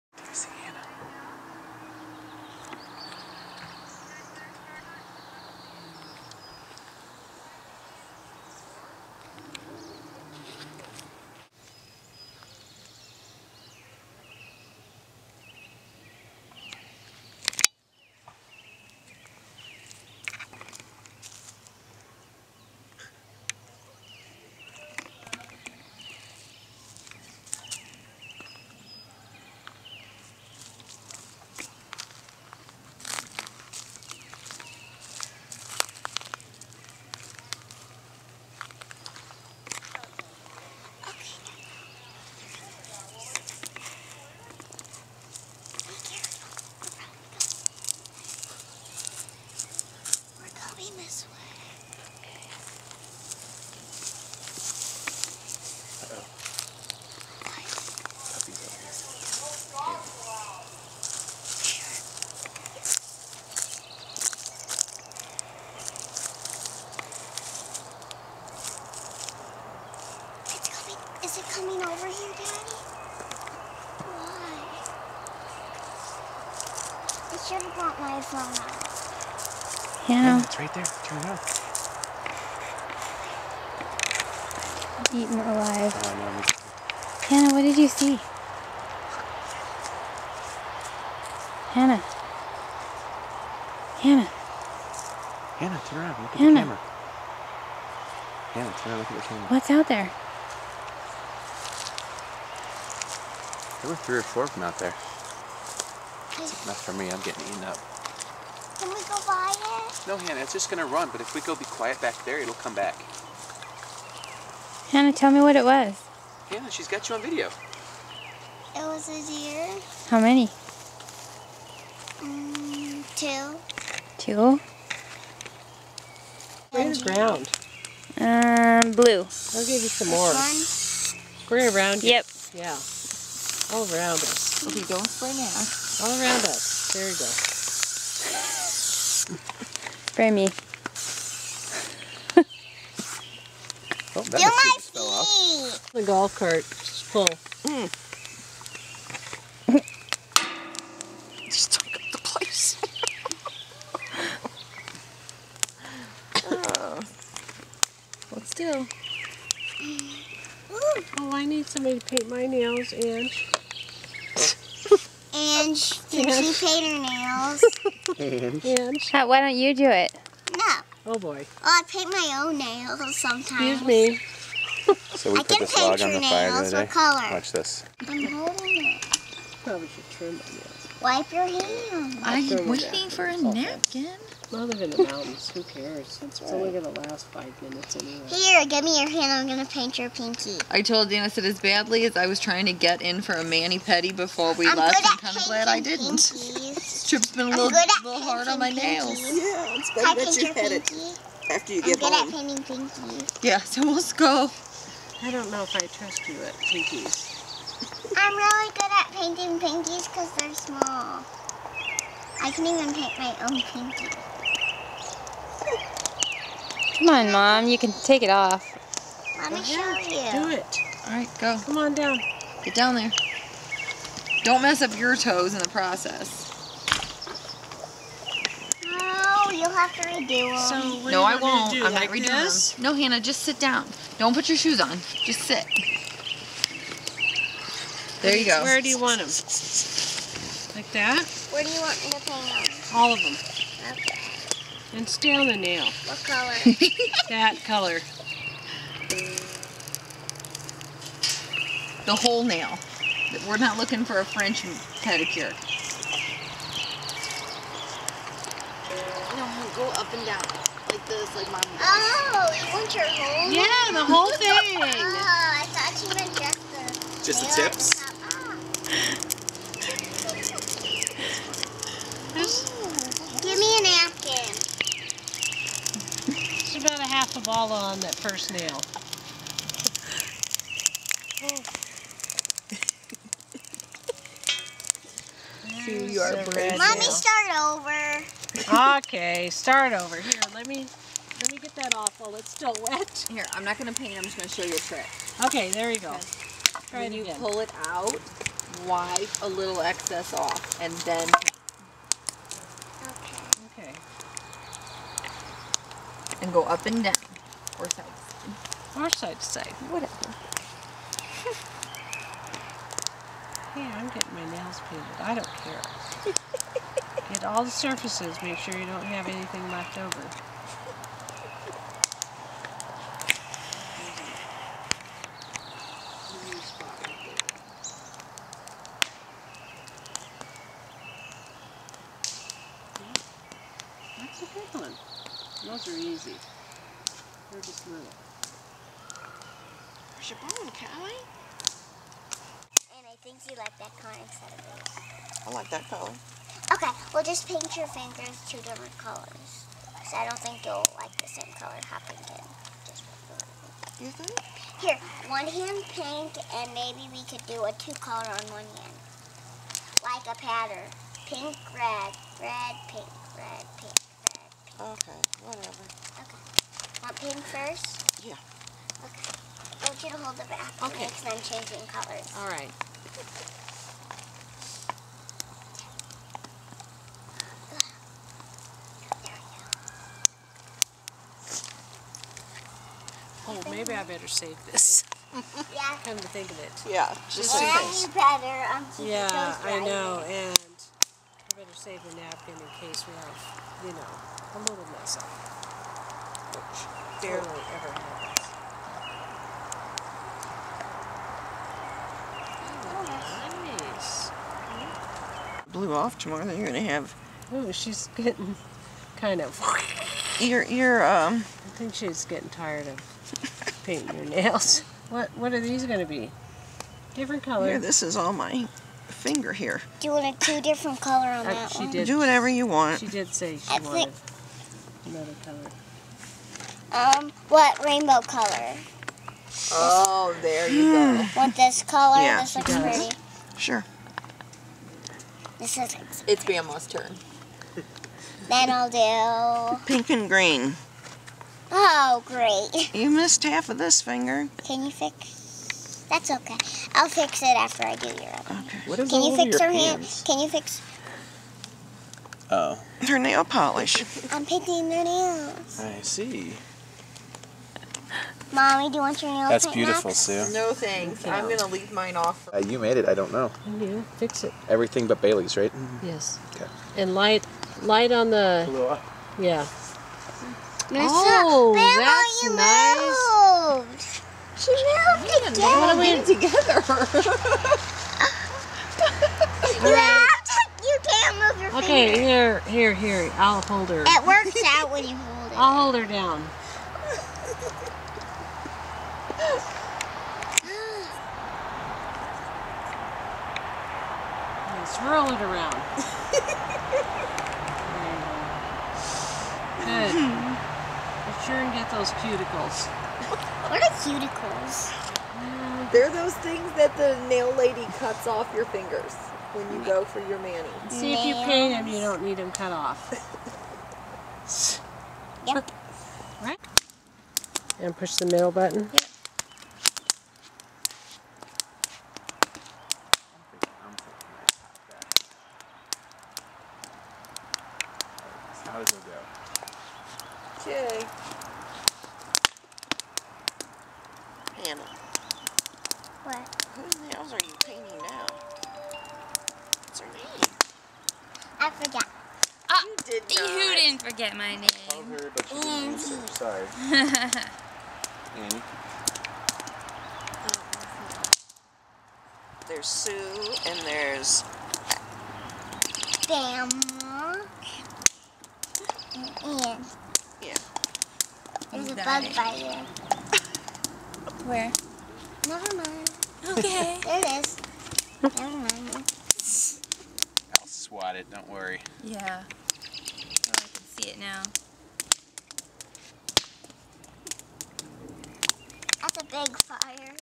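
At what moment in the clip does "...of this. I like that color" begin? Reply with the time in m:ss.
5:44.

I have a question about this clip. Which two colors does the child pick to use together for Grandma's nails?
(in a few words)
Pink and green.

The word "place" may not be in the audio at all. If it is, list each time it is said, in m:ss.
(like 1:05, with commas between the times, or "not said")
2:32.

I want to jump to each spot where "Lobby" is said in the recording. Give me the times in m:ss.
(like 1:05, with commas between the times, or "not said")
not said.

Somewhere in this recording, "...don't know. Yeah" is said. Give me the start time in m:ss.
7:43.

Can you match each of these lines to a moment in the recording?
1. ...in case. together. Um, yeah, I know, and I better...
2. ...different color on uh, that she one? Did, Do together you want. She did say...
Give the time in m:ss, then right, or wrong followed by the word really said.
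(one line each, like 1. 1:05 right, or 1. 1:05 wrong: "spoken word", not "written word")
1. 6:27 wrong: "better", not "together"
2. 7:00 wrong: "whatever", not "together".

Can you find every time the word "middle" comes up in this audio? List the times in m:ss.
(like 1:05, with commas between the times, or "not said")
8:38.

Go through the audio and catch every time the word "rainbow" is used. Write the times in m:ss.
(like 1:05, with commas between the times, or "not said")
7:07.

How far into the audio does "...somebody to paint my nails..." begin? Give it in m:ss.
2:41.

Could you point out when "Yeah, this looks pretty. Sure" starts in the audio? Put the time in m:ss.
7:12.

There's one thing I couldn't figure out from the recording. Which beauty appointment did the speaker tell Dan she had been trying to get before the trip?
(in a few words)
mani-pedi.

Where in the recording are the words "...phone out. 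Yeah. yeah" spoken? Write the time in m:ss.
1:18.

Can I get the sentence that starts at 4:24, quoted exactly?
oh, I thought you meant just the Just the tips?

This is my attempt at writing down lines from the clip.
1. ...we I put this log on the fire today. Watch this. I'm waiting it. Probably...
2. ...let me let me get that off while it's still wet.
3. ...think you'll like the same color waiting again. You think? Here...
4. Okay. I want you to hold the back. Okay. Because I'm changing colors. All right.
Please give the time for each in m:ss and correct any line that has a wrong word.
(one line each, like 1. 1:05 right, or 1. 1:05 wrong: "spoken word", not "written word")
1. 2:55 wrong: "holding", not "waiting"
2. 4:50 right
3. 5:50 wrong: "happening", not "waiting"
4. 6:09 right.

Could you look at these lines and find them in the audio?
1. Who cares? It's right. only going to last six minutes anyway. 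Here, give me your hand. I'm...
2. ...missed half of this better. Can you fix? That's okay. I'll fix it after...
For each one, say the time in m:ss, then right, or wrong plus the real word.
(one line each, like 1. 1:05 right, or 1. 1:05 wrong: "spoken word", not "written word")
1. 3:05 wrong: "five", not "six"
2. 7:23 wrong: "finger", not "better".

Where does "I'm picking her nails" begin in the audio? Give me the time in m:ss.
7:34.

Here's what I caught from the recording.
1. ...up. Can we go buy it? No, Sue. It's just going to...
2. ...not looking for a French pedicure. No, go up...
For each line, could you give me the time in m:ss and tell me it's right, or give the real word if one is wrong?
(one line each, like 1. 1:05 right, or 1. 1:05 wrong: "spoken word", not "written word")
1. 1:47 wrong: "Hannah", not "Sue"
2. 4:13 right.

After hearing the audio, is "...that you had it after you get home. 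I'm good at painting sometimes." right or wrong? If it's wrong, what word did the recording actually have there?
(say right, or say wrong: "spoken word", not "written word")
wrong: "pinkies", not "sometimes".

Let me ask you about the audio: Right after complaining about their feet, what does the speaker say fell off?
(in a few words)
The golf cart.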